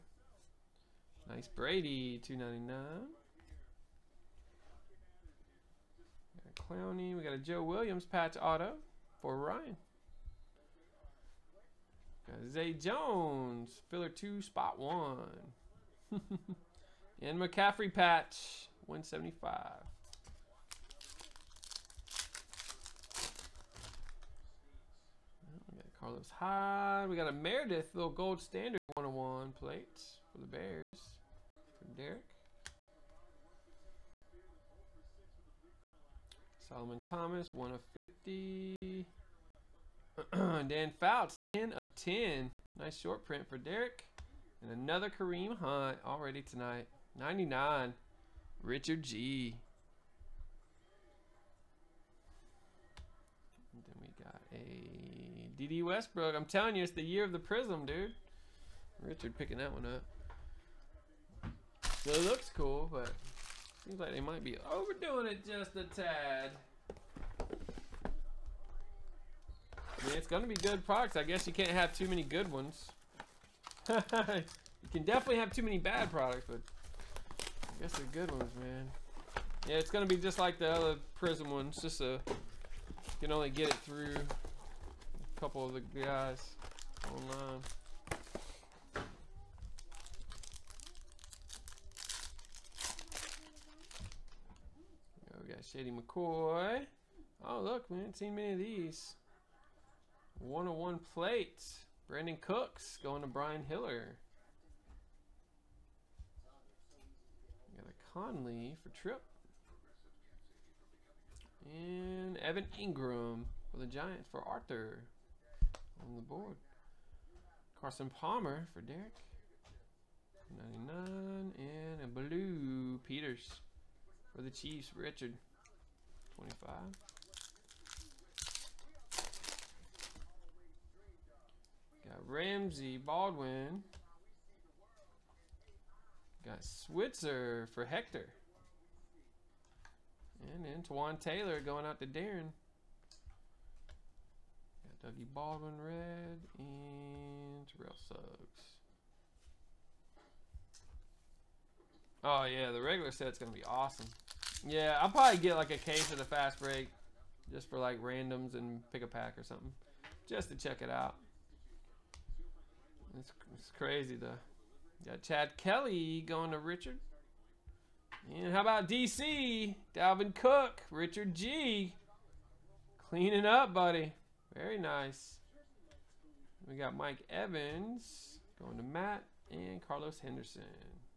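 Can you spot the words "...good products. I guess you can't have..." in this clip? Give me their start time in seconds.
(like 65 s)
70 s.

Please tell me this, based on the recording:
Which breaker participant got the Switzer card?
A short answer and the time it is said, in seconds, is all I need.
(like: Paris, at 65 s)
Hector, at 137 s.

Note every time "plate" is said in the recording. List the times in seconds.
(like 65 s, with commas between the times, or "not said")
29 s, 101 s.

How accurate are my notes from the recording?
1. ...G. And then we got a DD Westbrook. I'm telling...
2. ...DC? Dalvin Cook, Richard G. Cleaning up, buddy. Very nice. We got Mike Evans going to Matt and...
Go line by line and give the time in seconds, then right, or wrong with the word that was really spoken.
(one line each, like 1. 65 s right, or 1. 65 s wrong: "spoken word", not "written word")
1. 49 s right
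2. 168 s right.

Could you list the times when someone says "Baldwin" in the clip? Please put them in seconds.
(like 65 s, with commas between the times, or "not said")
132 s, 145 s.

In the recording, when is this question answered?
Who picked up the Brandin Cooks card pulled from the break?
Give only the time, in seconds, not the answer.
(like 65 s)
103 s.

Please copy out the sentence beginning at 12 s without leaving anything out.
Zay Jones, filler two, spot one.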